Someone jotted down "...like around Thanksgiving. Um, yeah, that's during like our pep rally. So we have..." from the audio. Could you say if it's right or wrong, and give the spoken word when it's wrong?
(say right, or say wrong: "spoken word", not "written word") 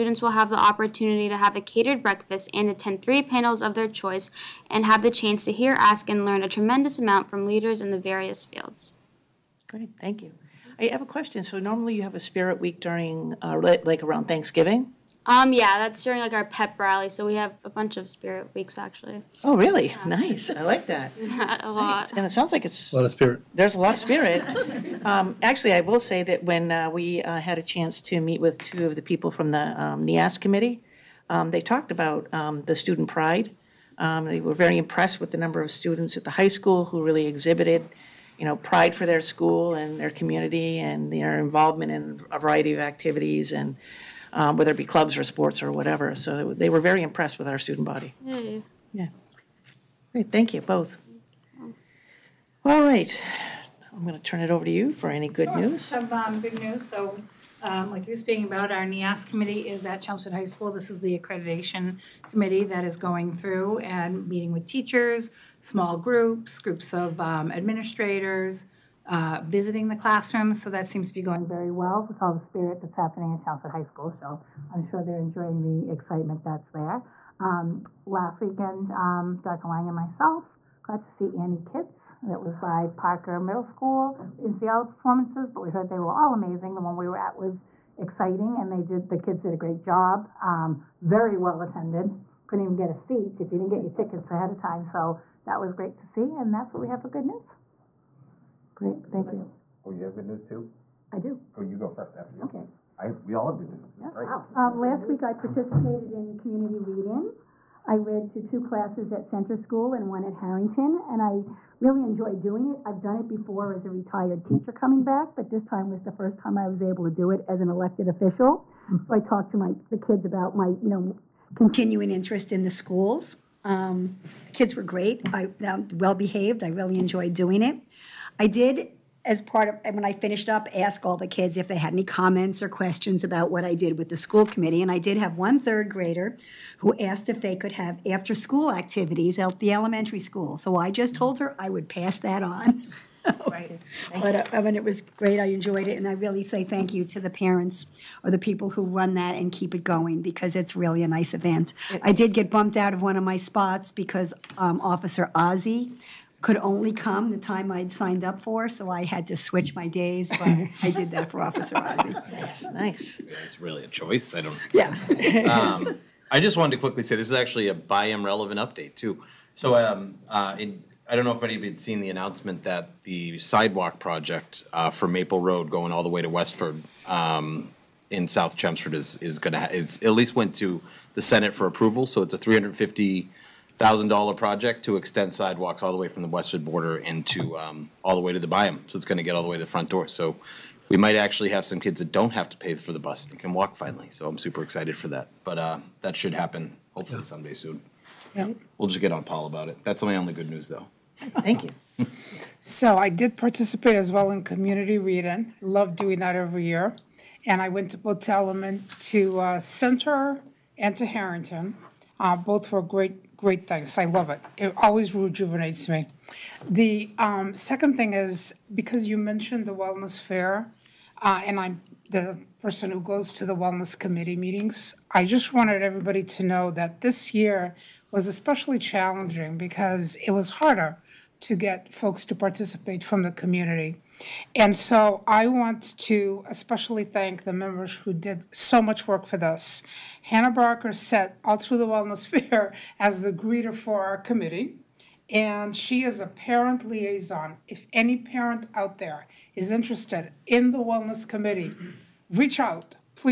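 right.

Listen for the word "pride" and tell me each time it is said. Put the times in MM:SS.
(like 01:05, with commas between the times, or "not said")
00:33, 00:38.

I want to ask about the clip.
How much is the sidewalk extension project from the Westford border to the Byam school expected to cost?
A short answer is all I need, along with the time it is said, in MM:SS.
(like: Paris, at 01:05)
$350,000, at 03:02.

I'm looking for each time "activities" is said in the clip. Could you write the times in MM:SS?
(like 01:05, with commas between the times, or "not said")
00:42, 02:18.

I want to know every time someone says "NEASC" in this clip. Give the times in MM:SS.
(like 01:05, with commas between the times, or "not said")
00:30, 00:58.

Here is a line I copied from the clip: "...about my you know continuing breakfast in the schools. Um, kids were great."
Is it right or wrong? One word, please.
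wrong.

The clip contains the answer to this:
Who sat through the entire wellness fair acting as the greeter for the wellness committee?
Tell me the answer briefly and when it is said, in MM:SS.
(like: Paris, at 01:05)
Hannah Barker, at 04:00.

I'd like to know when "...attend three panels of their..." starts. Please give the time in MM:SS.
00:02.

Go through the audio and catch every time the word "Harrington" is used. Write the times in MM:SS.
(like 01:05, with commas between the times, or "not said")
01:50, 03:31.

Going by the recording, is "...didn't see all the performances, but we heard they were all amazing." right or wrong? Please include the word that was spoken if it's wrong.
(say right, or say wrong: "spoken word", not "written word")
right.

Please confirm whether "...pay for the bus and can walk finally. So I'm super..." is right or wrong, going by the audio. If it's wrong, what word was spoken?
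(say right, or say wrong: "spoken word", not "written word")
right.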